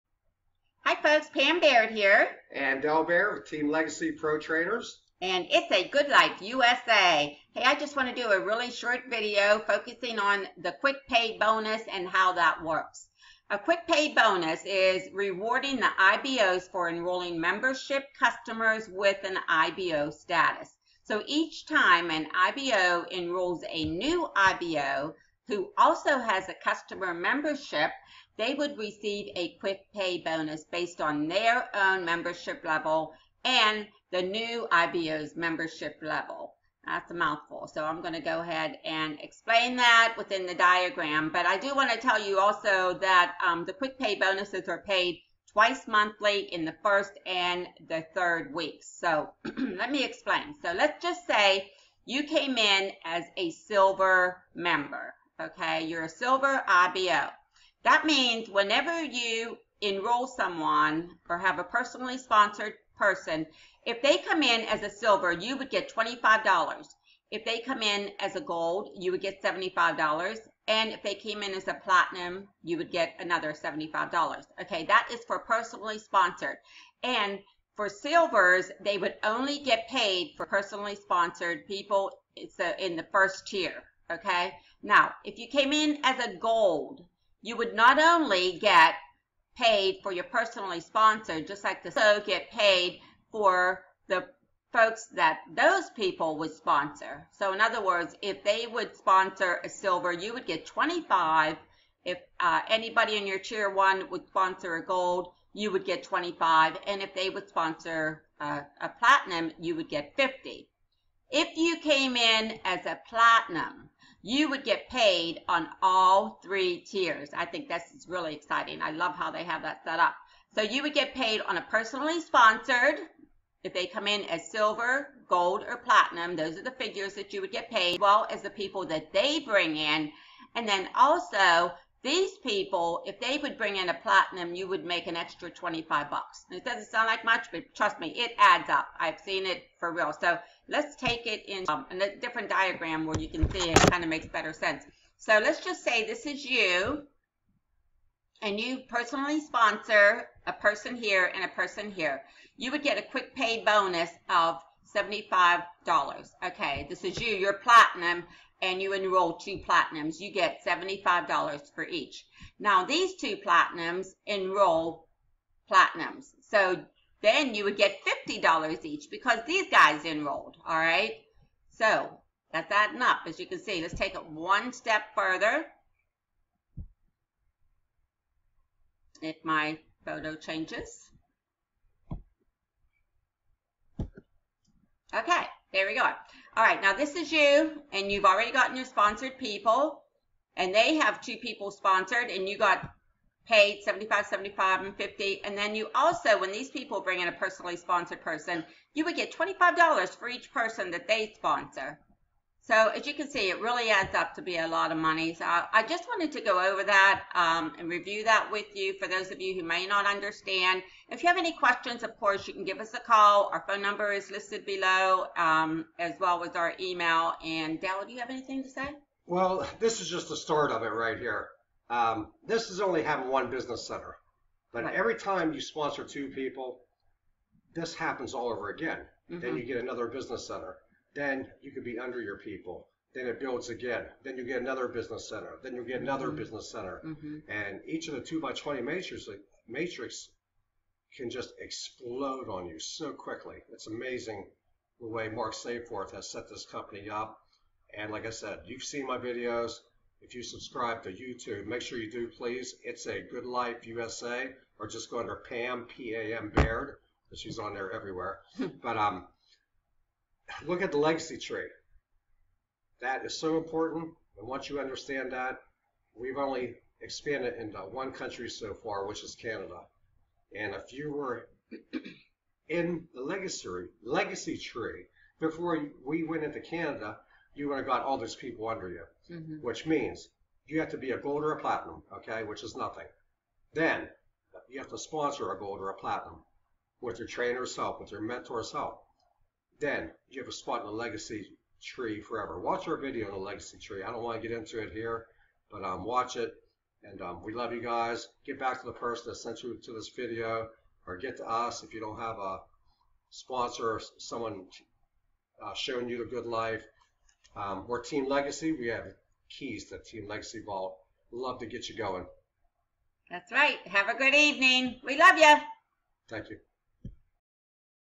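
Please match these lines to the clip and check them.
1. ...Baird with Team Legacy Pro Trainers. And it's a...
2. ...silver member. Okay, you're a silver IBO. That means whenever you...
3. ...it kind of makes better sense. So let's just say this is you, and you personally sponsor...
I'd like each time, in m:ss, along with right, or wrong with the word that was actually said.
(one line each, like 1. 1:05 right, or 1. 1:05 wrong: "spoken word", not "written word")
1. 0:03 right
2. 0:53 right
3. 2:23 right.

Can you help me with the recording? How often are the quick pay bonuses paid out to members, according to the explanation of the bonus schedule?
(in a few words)
Twice monthly.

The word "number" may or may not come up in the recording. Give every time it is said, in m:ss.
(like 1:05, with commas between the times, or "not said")
3:33.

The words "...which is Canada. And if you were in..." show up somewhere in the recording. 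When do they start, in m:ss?
4:29.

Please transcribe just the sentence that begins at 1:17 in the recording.
And for silvers, they would only get paid for personally sponsored people so in the first tier.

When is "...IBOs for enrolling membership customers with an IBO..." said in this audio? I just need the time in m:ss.
0:15.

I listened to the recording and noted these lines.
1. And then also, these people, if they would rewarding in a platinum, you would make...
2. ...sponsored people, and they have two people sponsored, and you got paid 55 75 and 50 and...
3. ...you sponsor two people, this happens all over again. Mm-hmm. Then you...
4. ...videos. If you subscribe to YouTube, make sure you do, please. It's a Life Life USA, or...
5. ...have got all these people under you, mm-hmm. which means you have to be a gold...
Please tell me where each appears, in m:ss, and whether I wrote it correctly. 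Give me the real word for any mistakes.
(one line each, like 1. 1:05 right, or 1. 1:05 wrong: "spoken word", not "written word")
1. 2:10 wrong: "bring", not "rewarding"
2. 3:08 wrong: "75", not "55"
3. 3:45 right
4. 4:09 wrong: "Good", not "Life"
5. 4:37 right.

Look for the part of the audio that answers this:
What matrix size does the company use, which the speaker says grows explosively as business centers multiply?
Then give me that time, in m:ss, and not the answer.
3:58.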